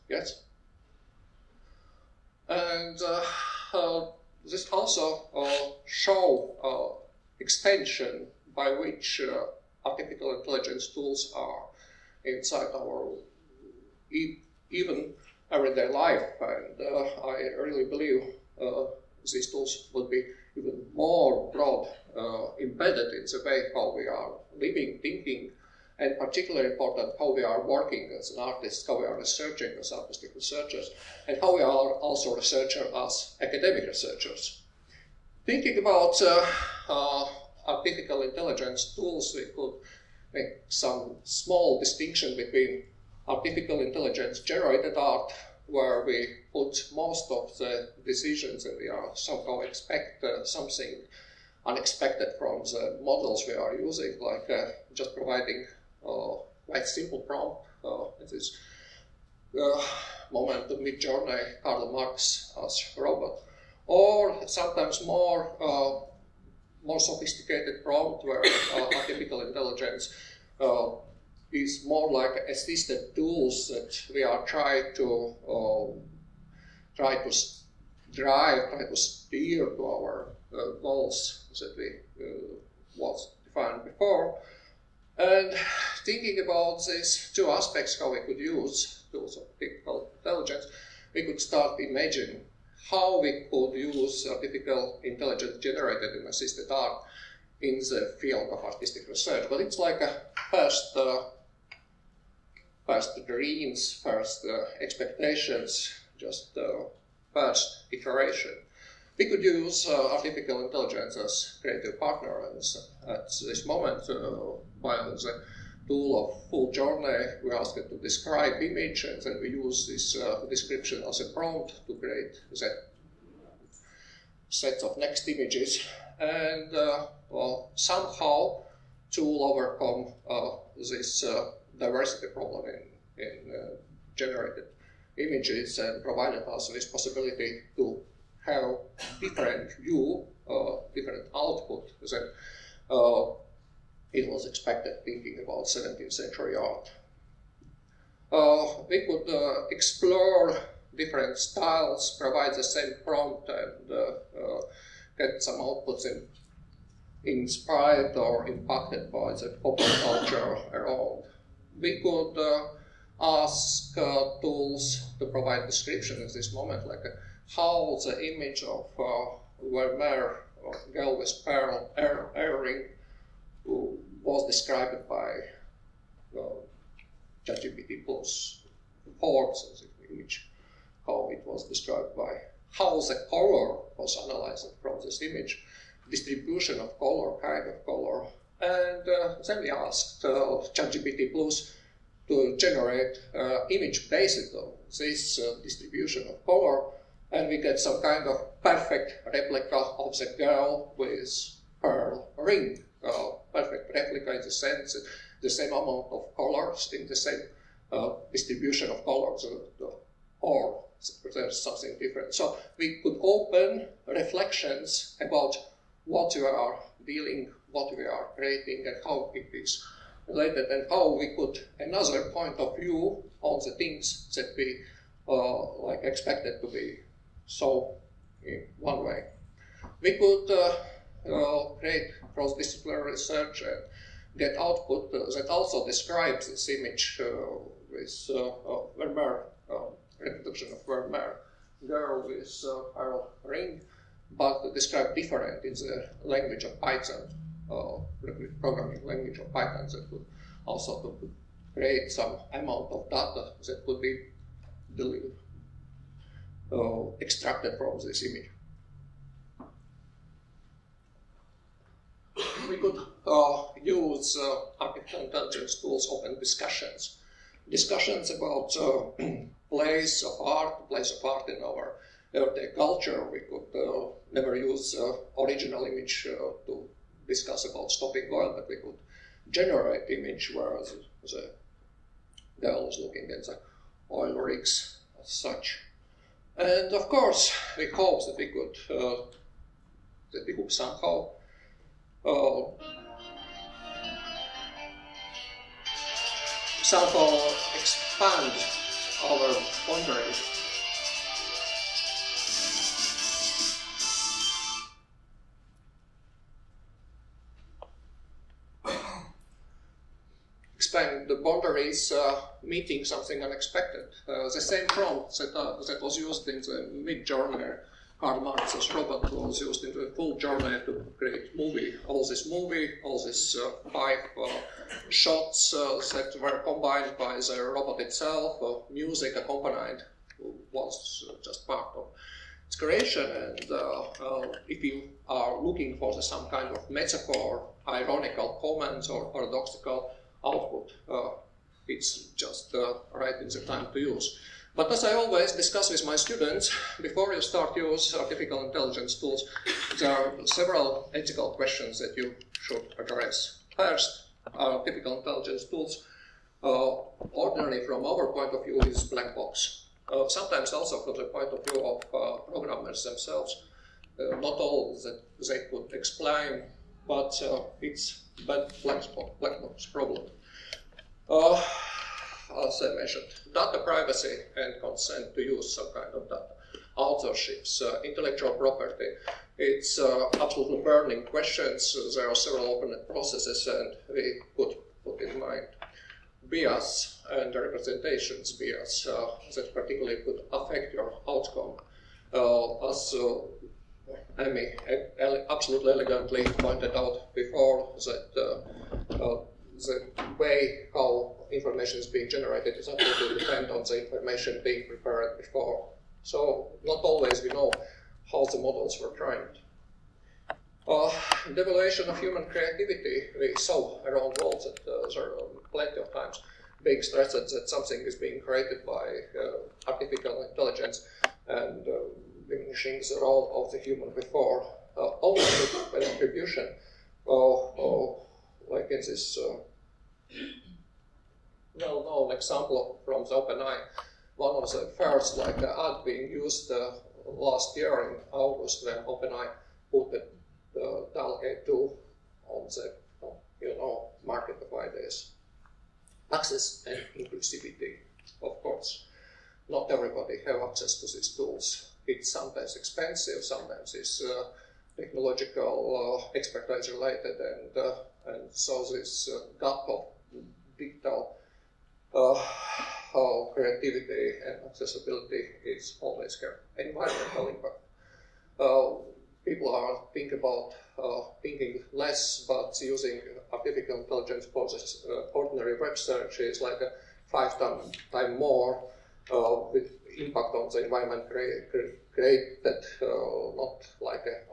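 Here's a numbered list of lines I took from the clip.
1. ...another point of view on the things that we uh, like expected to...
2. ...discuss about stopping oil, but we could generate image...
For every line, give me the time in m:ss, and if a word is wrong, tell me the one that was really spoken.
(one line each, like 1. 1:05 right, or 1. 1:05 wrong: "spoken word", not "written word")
1. 3:41 right
2. 4:37 right.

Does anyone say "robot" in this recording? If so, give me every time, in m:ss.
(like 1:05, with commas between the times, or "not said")
1:02, 5:27.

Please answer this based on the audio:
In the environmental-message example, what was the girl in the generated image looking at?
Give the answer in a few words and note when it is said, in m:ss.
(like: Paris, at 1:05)
oil rigs, at 4:44.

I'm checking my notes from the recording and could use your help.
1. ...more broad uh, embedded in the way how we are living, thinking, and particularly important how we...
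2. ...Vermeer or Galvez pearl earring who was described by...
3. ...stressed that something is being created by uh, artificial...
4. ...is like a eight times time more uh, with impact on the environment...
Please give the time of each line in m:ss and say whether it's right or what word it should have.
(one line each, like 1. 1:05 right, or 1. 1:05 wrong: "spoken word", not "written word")
1. 0:20 right
2. 2:49 right
3. 6:57 right
4. 7:56 wrong: "five", not "eight".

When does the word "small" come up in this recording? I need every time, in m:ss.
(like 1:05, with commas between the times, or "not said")
0:41.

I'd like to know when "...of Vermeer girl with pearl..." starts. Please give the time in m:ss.
4:00.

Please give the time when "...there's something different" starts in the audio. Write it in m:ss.
3:31.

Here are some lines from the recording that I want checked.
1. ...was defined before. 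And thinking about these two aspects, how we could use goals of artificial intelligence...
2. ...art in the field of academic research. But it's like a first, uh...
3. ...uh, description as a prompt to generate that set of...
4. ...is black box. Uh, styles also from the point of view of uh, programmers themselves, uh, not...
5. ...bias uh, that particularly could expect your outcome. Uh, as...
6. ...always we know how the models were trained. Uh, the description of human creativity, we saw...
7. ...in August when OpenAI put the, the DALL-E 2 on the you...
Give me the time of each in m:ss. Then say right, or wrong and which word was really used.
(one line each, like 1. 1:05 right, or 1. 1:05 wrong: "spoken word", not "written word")
1. 1:22 wrong: "tools", not "goals"
2. 1:36 wrong: "artistic", not "academic"
3. 2:00 wrong: "create", not "generate"
4. 5:58 wrong: "sometimes", not "styles"
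5. 6:28 wrong: "affect", not "expect"
6. 6:47 wrong: "evaluation", not "description"
7. 7:18 right.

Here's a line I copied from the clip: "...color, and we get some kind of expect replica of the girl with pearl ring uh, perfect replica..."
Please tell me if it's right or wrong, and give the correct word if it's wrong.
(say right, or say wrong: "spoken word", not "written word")
wrong: "perfect", not "expect".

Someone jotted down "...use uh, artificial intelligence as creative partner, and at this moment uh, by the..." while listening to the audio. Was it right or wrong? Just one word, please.
right.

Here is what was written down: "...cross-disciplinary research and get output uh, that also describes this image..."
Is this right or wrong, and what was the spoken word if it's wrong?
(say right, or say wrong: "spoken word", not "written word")
right.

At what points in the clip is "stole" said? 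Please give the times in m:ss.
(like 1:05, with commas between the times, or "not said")
not said.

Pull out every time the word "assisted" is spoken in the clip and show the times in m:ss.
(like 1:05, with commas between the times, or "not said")
1:12, 1:36.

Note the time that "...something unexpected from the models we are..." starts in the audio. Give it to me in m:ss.
0:50.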